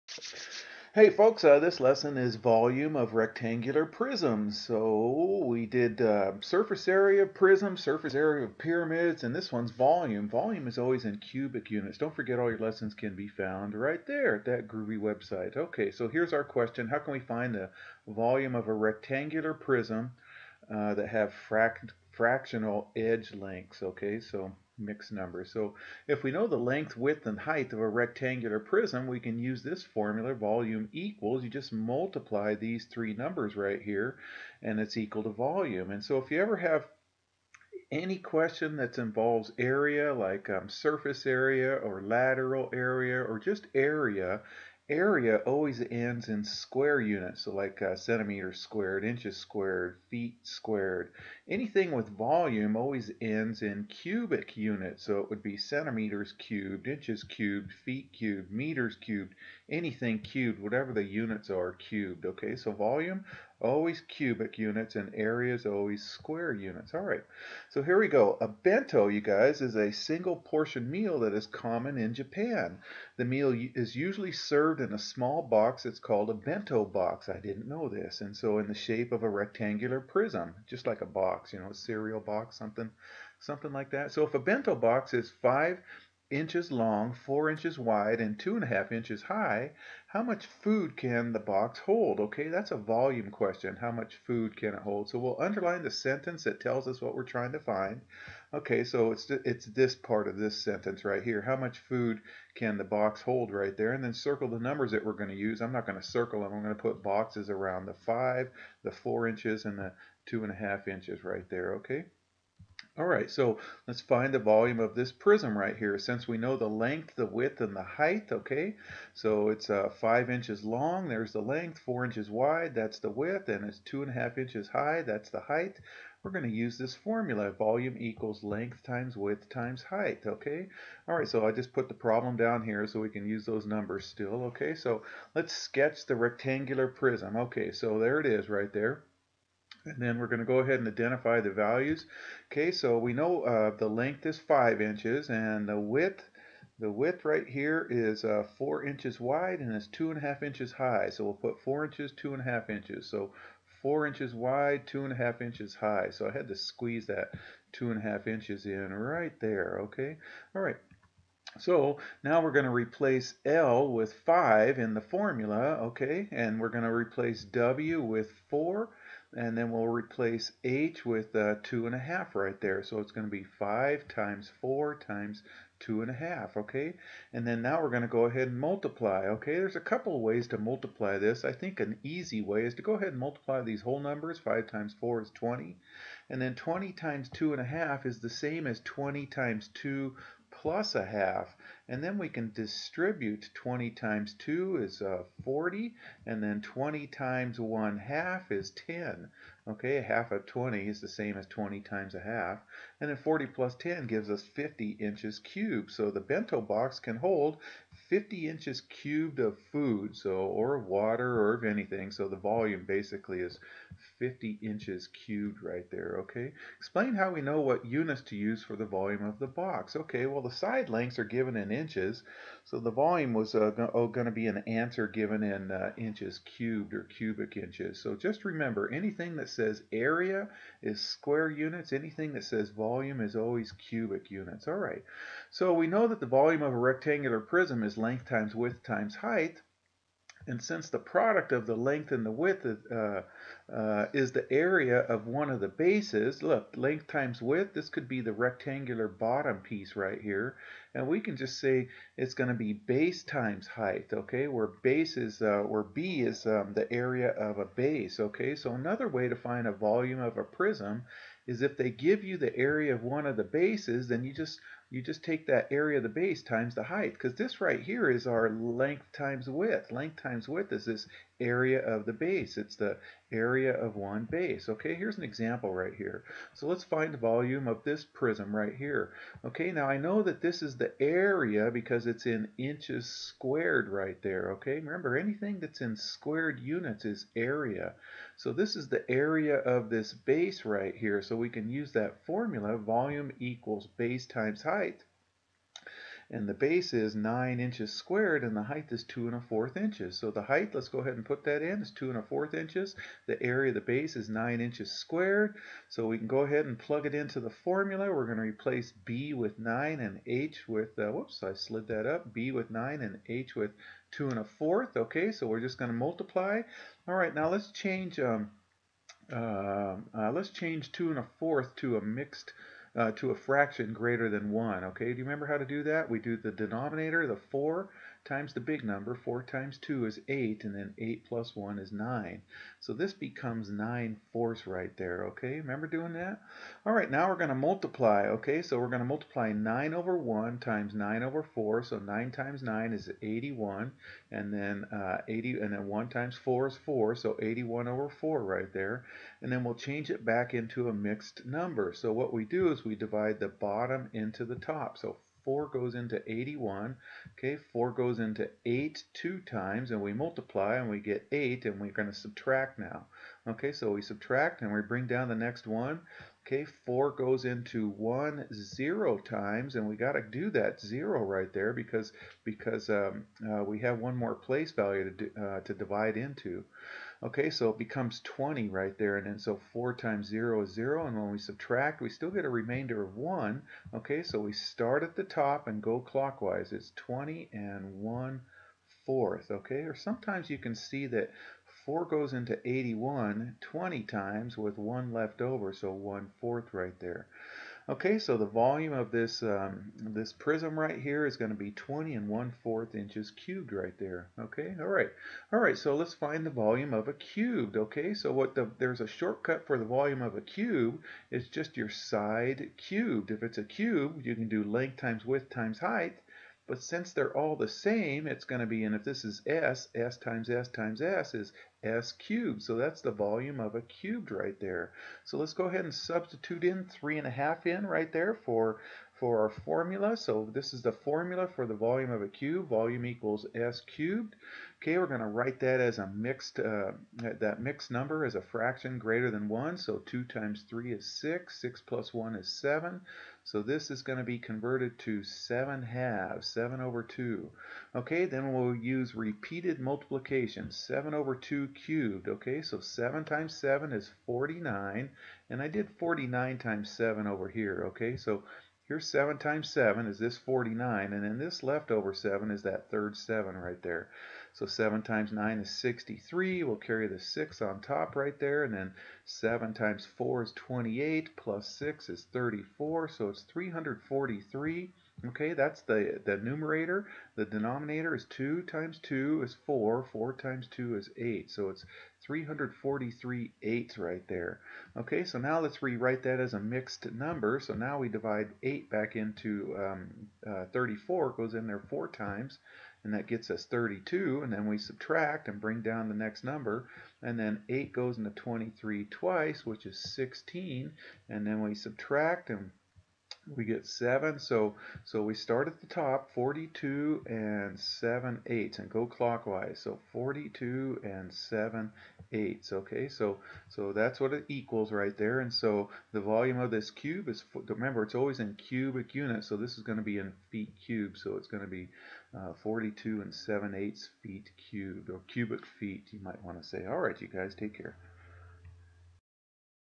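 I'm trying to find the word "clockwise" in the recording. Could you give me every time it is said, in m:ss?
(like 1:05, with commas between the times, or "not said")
6:25, 8:29.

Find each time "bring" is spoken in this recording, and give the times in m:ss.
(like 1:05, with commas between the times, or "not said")
6:04, 8:15.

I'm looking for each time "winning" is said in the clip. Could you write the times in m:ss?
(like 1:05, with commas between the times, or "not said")
not said.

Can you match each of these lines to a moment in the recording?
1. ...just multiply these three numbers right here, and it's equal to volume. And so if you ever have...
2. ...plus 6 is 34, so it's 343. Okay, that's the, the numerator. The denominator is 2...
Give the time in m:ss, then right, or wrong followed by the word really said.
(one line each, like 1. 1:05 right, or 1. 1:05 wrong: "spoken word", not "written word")
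1. 0:31 right
2. 7:51 right.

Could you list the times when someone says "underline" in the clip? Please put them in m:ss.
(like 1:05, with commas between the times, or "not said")
1:35.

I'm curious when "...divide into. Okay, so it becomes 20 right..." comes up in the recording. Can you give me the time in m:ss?
6:15.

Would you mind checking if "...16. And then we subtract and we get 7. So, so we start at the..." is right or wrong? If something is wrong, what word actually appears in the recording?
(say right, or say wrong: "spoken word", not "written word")
right.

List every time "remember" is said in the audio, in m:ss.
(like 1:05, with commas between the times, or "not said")
3:48, 4:44, 5:25, 5:35, 8:37.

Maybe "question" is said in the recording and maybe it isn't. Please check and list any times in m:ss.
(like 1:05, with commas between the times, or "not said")
0:16, 0:38, 1:33.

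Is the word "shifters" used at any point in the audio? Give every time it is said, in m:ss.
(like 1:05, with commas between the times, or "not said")
not said.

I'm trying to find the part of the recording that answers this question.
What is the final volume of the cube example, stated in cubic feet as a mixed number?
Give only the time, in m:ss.
8:42.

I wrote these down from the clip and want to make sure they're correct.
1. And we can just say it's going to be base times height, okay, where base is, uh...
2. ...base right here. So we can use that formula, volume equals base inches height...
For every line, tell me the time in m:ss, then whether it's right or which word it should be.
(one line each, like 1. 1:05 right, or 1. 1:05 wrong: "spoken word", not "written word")
1. 4:10 right
2. 4:50 wrong: "times", not "inches".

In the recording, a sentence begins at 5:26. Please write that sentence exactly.
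We do the denominator, the 4, times the big number.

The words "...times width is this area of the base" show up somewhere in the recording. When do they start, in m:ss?
4:30.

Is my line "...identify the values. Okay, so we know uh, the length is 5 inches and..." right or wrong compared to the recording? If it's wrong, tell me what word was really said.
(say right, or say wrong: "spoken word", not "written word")
right.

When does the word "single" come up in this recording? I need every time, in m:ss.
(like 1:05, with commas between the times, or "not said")
1:09.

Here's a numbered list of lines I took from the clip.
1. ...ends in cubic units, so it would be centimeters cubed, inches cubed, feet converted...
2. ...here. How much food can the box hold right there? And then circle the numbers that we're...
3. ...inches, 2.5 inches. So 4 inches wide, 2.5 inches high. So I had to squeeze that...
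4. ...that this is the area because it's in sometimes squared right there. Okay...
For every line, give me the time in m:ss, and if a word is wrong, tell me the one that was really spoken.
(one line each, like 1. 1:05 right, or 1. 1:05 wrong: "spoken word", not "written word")
1. 0:53 wrong: "cubed", not "converted"
2. 1:41 right
3. 2:31 right
4. 4:40 wrong: "inches", not "sometimes".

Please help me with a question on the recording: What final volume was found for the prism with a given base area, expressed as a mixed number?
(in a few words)
20 1/4 cubic inches.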